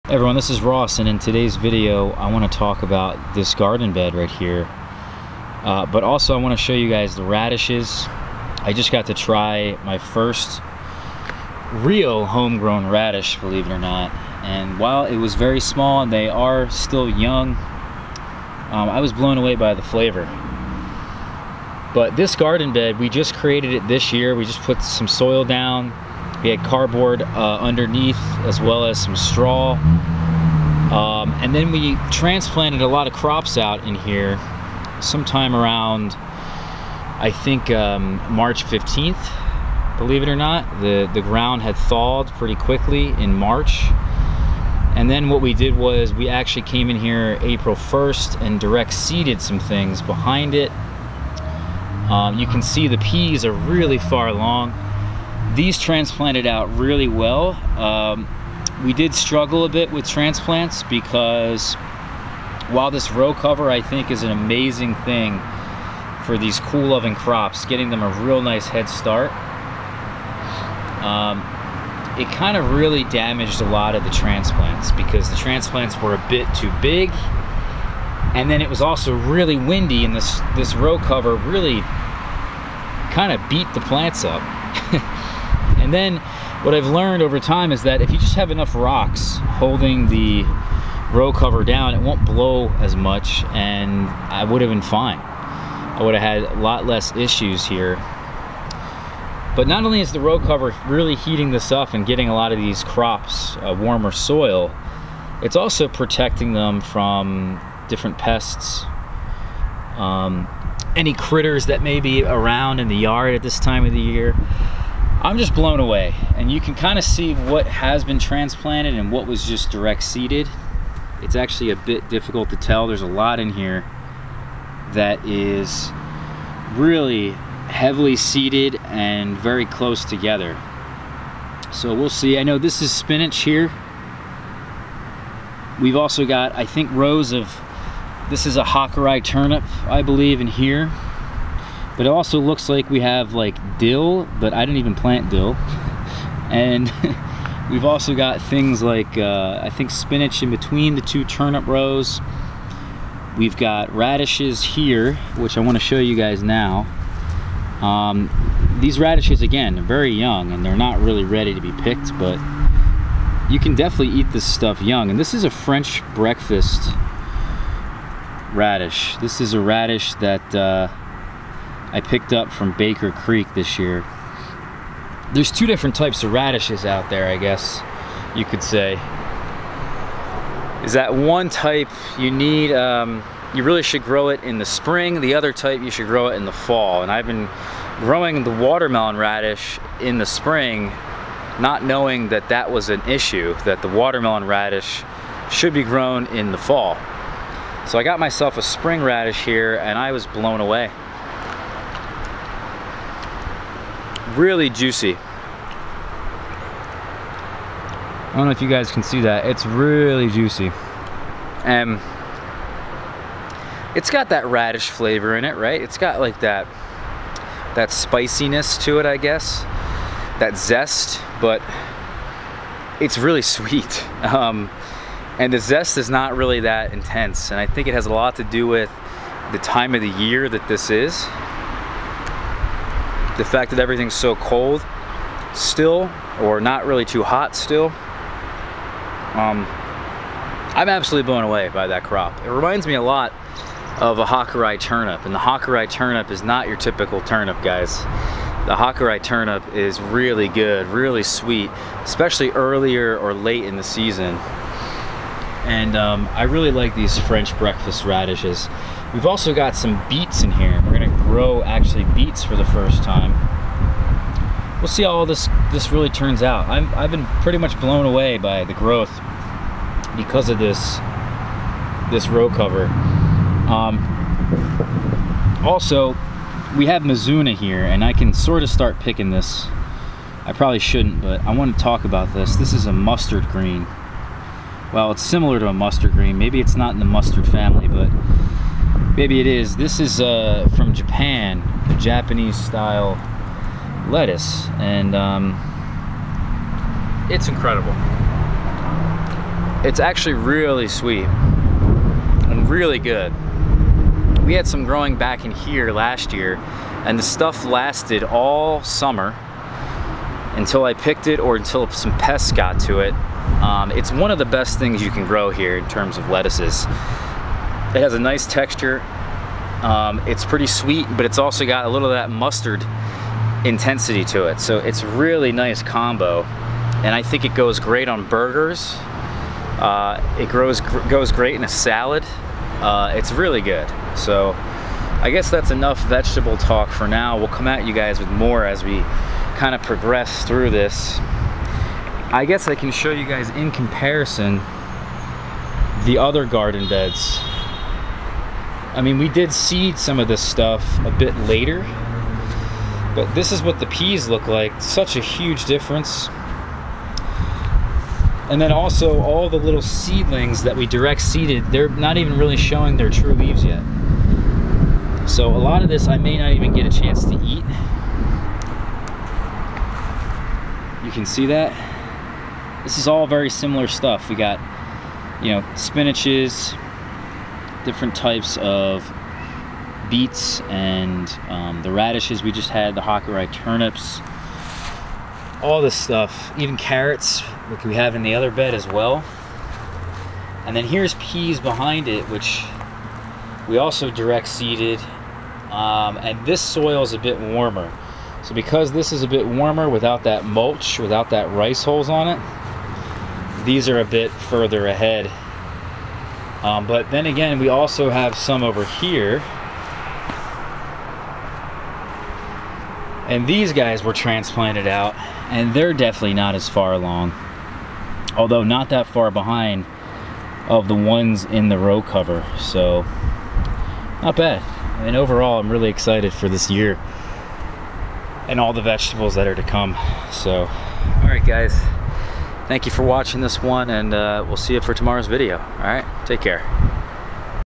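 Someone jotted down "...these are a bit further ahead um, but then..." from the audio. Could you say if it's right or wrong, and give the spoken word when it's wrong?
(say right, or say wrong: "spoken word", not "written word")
right.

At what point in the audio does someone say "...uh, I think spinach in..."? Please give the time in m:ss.
2:29.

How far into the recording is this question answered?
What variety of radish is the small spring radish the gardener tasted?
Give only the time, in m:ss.
2:45.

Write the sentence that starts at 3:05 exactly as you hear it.
The other type you should grow it in the fall.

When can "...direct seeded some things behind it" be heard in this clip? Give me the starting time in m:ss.
0:48.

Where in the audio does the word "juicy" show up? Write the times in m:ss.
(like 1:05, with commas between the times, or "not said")
3:24, 3:30.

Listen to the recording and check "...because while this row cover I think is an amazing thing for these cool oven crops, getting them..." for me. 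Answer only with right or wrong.
right.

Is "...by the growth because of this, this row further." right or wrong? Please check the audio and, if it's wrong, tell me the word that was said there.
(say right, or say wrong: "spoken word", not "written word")
wrong: "cover", not "further".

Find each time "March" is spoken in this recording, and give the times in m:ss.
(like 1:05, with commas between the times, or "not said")
0:38, 0:43.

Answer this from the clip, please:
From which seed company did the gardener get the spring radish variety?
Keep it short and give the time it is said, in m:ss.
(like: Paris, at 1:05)
Baker Creek, at 2:52.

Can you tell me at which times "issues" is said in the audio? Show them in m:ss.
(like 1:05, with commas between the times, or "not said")
1:37, 3:13.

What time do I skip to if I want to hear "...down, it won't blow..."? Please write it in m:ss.
1:31.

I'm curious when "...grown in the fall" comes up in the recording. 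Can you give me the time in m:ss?
3:15.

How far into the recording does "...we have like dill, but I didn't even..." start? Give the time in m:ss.
2:22.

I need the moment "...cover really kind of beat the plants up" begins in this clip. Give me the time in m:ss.
1:20.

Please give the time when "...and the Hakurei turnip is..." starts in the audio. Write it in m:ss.
4:05.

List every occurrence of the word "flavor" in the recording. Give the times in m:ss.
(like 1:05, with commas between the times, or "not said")
0:19, 3:34.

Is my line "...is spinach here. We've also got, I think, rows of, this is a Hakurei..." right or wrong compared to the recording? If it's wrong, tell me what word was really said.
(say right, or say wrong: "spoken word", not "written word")
right.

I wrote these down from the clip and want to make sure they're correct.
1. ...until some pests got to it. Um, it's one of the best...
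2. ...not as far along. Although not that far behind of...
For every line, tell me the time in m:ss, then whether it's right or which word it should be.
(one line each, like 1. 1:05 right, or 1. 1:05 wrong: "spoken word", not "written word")
1. 5:11 right
2. 6:56 right.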